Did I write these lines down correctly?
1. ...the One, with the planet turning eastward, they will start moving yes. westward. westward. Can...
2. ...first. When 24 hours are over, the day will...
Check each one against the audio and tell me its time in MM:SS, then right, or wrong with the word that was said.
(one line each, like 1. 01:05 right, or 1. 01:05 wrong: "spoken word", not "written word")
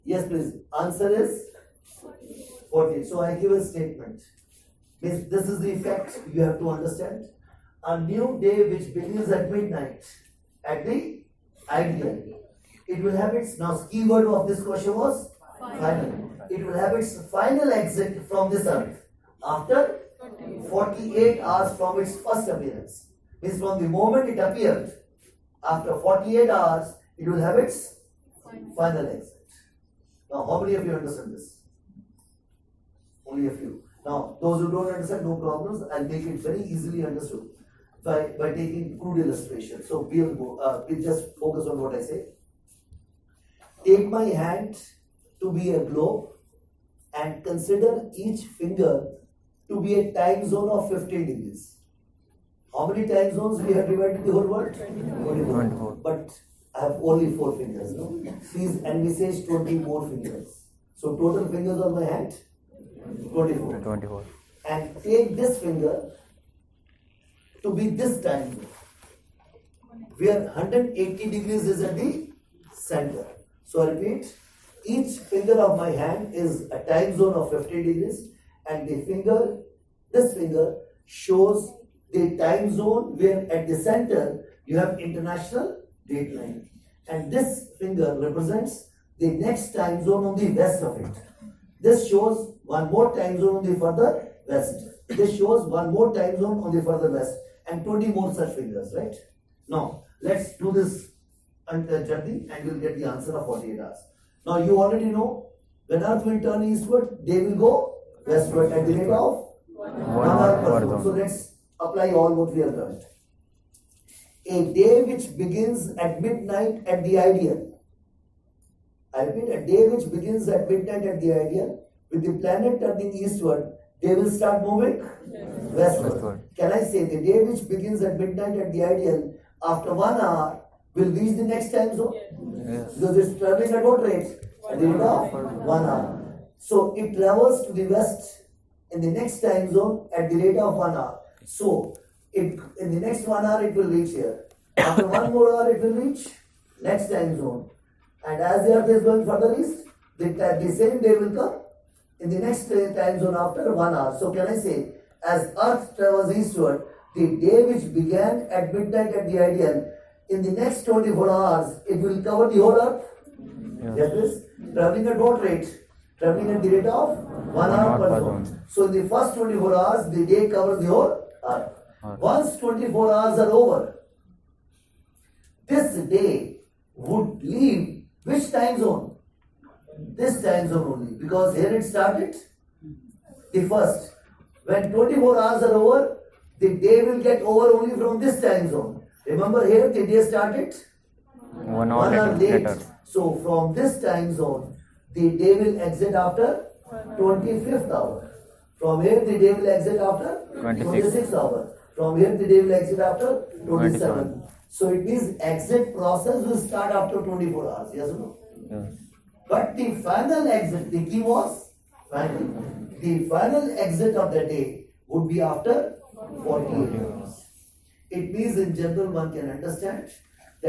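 1. 02:01 wrong: "IDL", not "One"
2. 03:03 right.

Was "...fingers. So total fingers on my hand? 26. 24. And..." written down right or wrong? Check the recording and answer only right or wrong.
wrong.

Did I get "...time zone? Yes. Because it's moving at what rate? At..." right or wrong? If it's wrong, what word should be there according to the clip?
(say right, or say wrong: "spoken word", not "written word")
wrong: "traveling", not "moving".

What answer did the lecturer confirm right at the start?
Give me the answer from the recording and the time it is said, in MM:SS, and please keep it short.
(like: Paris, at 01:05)
14, at 00:02.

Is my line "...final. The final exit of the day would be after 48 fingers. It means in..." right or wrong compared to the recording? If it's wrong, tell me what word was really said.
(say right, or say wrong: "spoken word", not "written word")
wrong: "hours", not "fingers".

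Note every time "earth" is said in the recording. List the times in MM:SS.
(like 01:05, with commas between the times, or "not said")
00:18, 01:46, 02:28, 02:35, 02:42, 02:51.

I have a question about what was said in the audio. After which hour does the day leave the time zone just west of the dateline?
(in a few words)
25th hour.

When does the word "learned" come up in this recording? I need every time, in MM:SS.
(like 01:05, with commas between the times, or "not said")
01:52.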